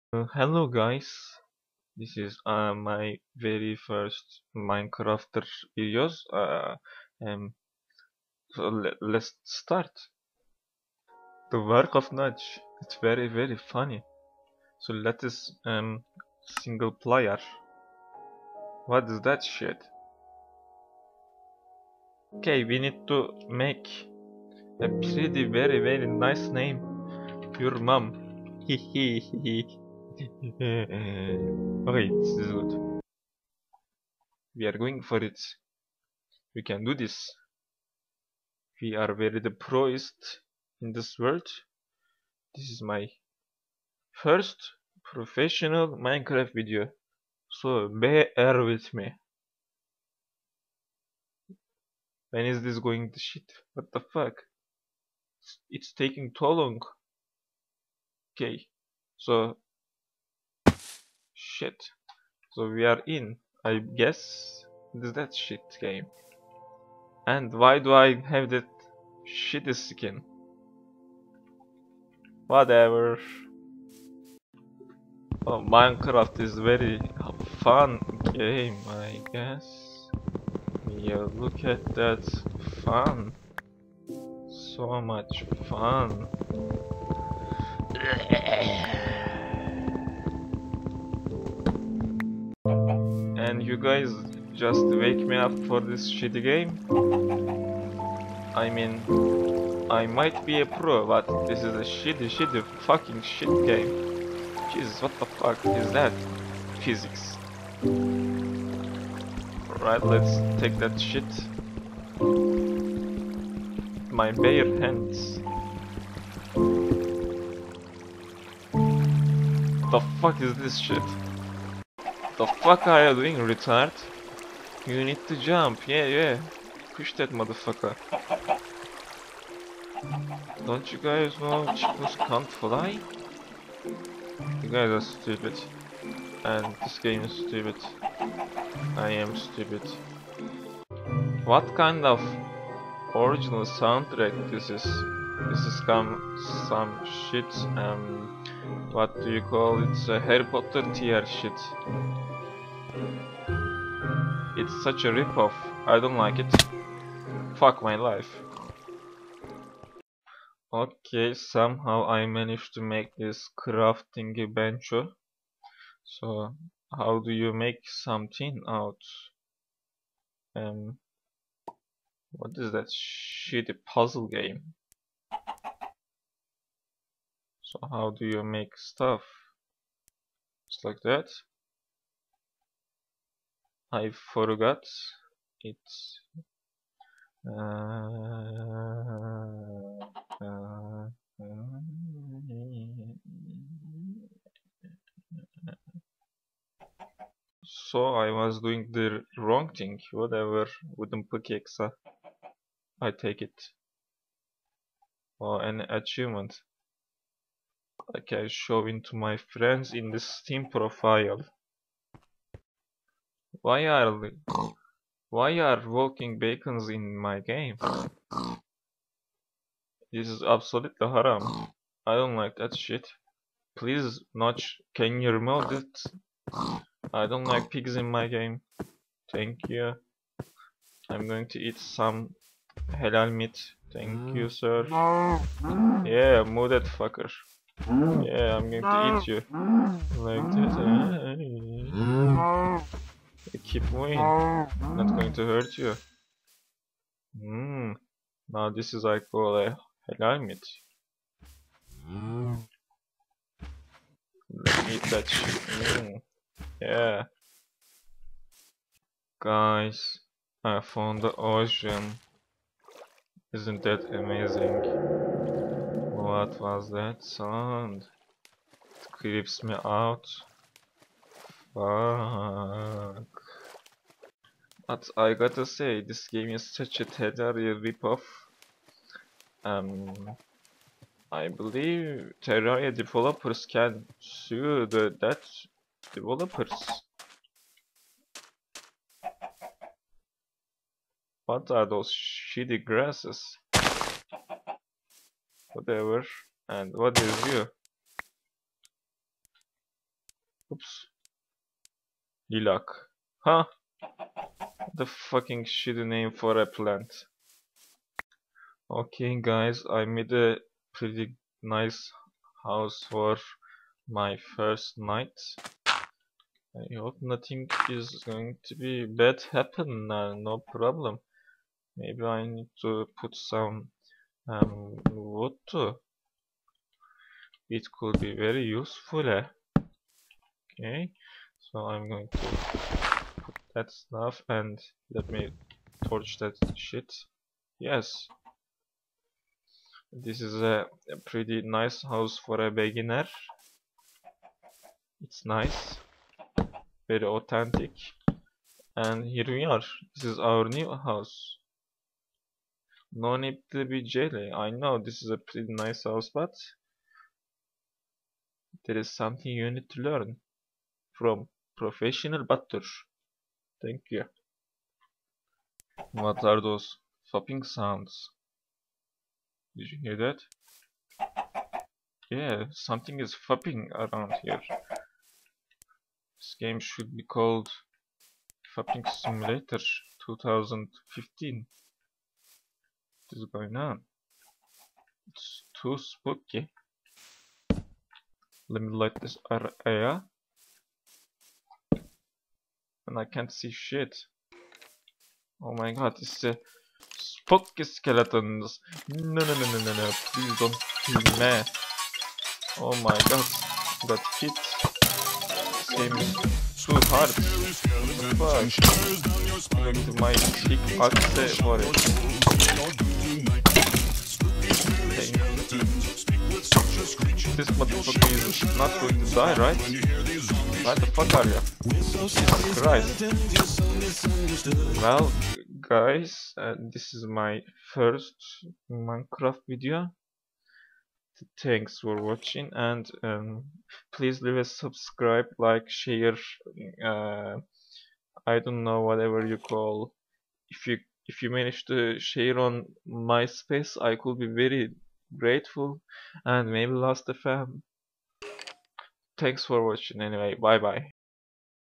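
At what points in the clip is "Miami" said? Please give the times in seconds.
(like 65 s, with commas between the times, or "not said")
not said.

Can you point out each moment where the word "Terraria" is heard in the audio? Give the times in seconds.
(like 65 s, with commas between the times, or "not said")
277 s, 282 s.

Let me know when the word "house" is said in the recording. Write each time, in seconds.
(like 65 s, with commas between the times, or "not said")
312 s, 342 s, 350 s, 356 s.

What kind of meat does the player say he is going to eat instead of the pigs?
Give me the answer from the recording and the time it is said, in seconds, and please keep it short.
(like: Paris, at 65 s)
Halal meat, at 232 s.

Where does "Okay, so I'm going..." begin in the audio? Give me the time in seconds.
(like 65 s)
330 s.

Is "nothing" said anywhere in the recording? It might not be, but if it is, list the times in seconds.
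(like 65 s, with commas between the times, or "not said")
317 s.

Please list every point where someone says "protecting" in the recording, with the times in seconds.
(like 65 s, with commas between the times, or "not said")
not said.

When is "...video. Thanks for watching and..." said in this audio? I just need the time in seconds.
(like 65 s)
429 s.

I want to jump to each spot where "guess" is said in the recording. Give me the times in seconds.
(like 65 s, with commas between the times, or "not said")
63 s, 79 s.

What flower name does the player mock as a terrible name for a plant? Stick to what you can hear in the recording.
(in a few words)
Lilac.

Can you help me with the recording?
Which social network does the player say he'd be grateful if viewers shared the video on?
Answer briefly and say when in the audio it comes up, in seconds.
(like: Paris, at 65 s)
MySpace, at 443 s.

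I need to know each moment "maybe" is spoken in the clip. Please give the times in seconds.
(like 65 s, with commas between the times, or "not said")
321 s, 446 s.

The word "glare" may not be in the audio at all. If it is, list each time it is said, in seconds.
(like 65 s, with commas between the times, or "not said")
not said.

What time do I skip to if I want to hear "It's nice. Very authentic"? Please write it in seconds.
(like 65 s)
345 s.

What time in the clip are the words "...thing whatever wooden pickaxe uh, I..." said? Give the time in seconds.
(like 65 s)
199 s.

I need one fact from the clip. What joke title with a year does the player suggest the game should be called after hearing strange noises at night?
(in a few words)
Fapping Simulator 2015.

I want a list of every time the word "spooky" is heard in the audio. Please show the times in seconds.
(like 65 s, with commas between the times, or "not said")
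385 s, 397 s.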